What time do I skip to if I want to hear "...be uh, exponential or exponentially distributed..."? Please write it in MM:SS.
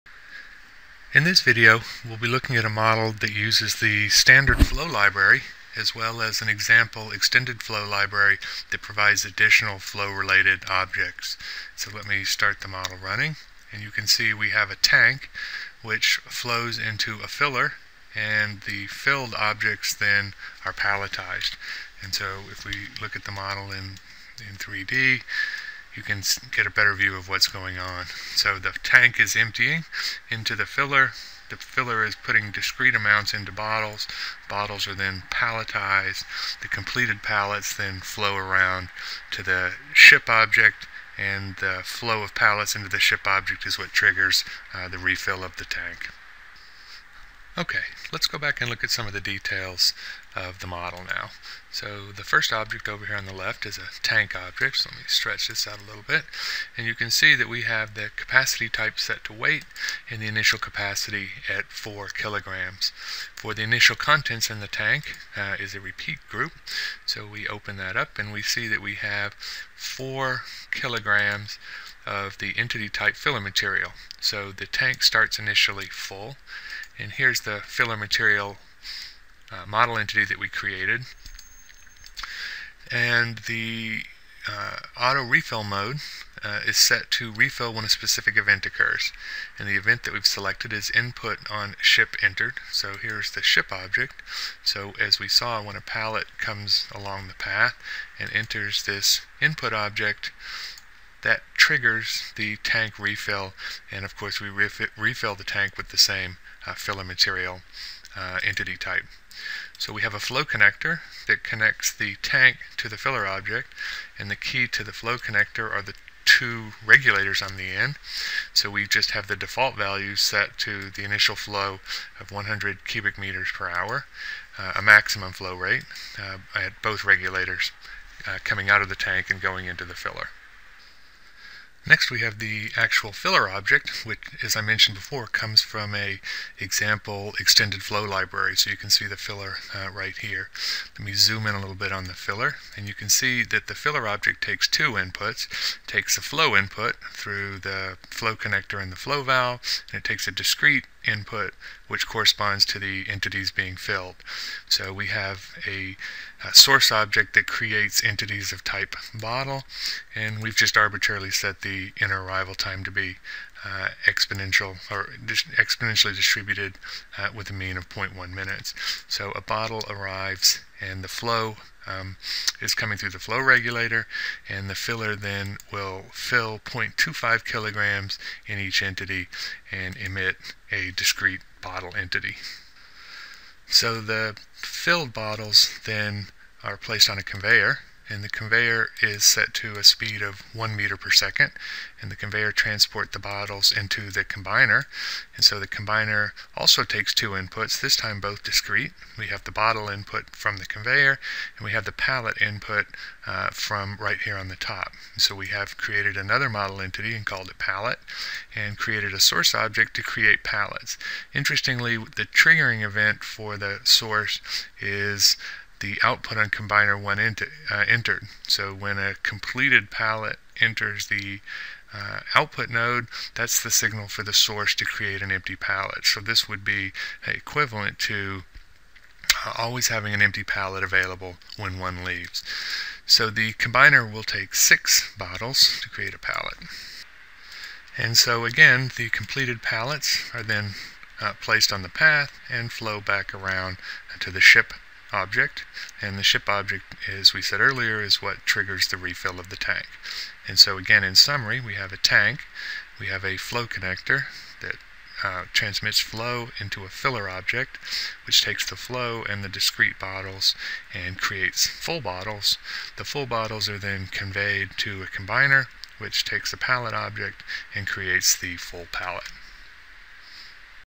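02:42.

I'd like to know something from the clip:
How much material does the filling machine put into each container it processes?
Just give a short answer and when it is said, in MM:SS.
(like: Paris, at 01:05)
0.25 kilograms, at 02:56.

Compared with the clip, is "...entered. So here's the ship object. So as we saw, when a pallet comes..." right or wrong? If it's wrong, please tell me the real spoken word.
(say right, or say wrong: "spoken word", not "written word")
right.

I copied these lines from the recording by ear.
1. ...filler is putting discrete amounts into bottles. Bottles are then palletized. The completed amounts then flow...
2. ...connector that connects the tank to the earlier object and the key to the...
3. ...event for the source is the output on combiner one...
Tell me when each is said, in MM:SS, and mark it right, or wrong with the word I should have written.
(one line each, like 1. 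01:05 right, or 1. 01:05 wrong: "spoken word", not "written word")
1. 00:31 wrong: "pallets", not "amounts"
2. 01:50 wrong: "filler", not "earlier"
3. 03:32 right.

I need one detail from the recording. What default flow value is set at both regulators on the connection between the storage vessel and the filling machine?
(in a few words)
100 cubic meters per hour.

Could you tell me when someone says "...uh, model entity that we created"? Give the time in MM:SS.
01:19.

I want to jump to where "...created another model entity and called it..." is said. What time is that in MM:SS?
03:25.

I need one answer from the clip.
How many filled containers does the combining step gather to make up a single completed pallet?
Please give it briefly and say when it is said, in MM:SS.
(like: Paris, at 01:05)
6, at 03:54.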